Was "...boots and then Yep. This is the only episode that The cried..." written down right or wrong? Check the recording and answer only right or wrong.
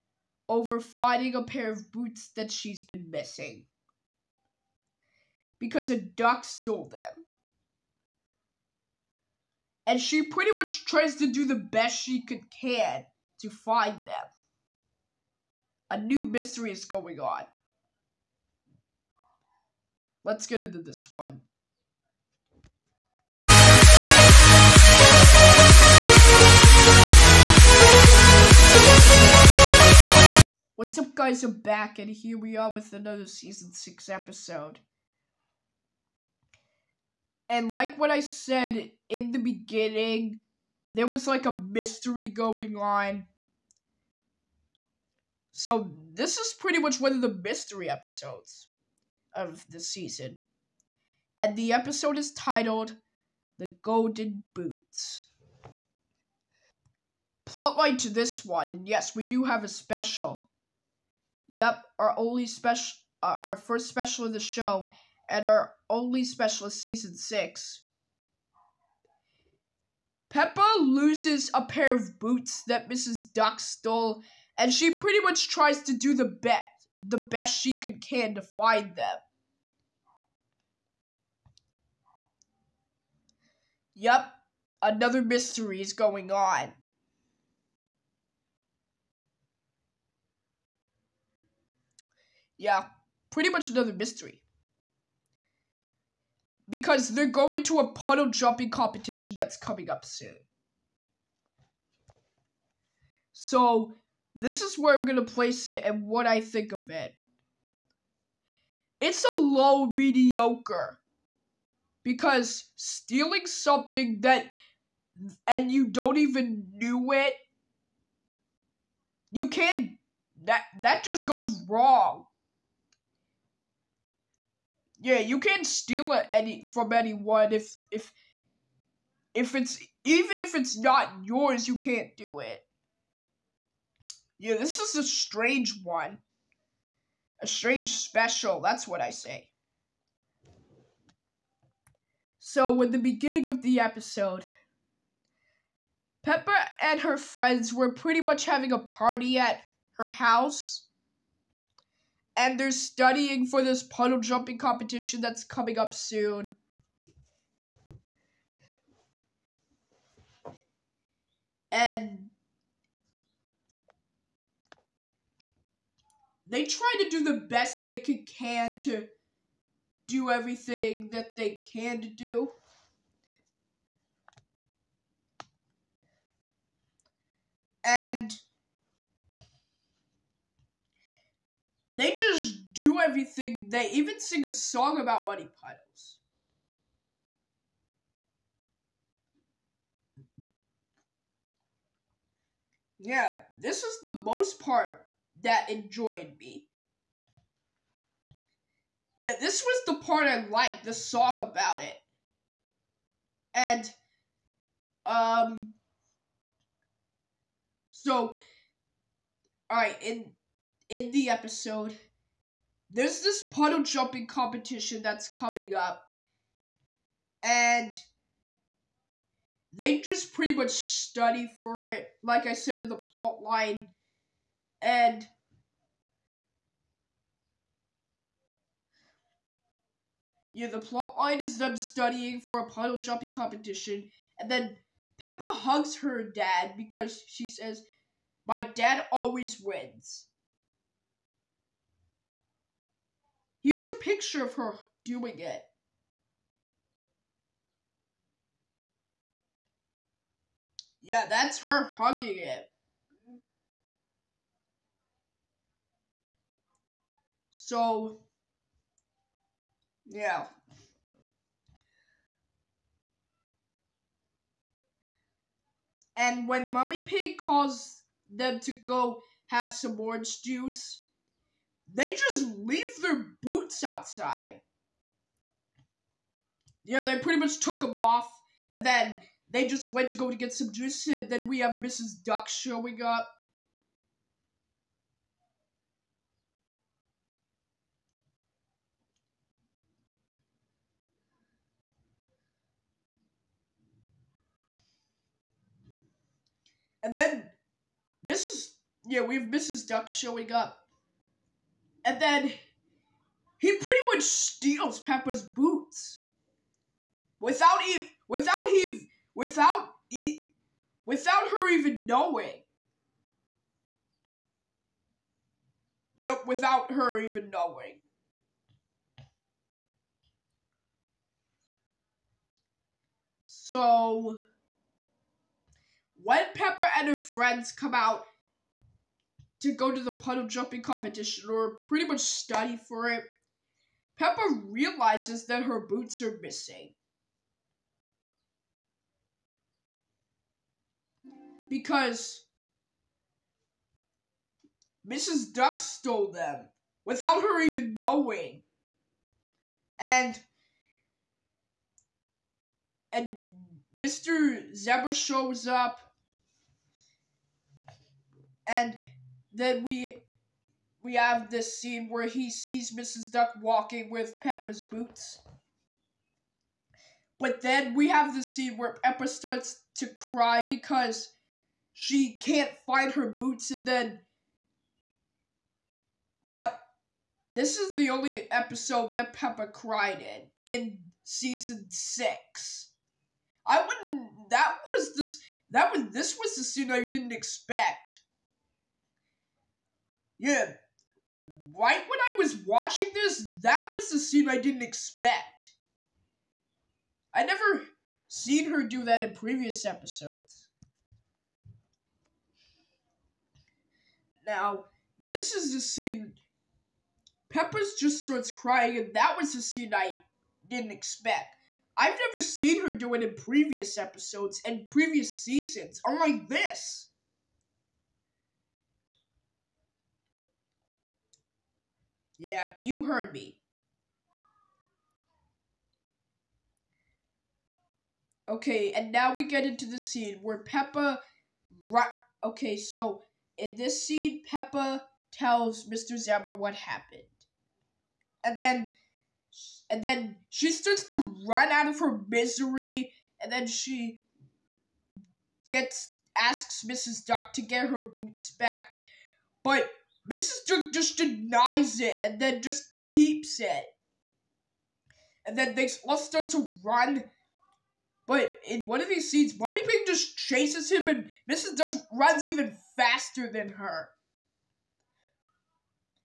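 wrong.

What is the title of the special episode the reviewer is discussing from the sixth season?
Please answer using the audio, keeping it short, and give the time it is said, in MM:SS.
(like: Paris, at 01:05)
The Golden Boots, at 00:53.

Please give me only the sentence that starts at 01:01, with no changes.
Yep, our only special, uh, our first special of the show, and our only special of season six.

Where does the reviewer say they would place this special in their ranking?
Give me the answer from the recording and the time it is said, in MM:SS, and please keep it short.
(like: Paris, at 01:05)
Low mediocre, at 01:49.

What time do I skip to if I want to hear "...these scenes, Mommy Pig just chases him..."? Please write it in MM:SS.
07:39.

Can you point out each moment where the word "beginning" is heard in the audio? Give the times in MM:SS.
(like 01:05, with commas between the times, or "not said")
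00:39, 02:22.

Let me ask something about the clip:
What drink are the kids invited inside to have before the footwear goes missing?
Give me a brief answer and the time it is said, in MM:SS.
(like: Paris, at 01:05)
Orange juice, at 04:29.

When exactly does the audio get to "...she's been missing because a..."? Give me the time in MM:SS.
00:02.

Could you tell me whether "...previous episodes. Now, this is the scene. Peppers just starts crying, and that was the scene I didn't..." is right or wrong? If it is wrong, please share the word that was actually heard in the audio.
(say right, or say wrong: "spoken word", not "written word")
right.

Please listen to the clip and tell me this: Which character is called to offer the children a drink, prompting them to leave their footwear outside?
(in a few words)
Mummy Pig.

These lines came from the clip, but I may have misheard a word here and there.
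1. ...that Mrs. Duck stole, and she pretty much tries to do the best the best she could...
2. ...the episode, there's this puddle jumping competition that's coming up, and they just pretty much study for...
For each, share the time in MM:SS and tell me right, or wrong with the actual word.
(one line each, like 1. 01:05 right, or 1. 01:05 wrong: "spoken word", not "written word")
1. 01:12 right
2. 03:31 right.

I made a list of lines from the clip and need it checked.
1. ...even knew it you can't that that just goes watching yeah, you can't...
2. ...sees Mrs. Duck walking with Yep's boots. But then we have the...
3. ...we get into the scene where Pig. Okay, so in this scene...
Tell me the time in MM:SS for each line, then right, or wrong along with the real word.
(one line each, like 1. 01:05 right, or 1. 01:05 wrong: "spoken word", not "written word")
1. 01:56 wrong: "wrong", not "watching"
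2. 06:02 wrong: "Peppa", not "Yep"
3. 07:09 wrong: "Peppa", not "Pig".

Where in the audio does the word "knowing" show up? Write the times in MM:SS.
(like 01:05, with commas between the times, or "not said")
05:12, 05:17, 05:47.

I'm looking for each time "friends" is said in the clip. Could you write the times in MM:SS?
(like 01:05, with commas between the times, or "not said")
02:27, 05:27.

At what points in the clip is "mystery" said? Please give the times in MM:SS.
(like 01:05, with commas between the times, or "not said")
00:16, 00:41, 00:47, 01:25, 01:33.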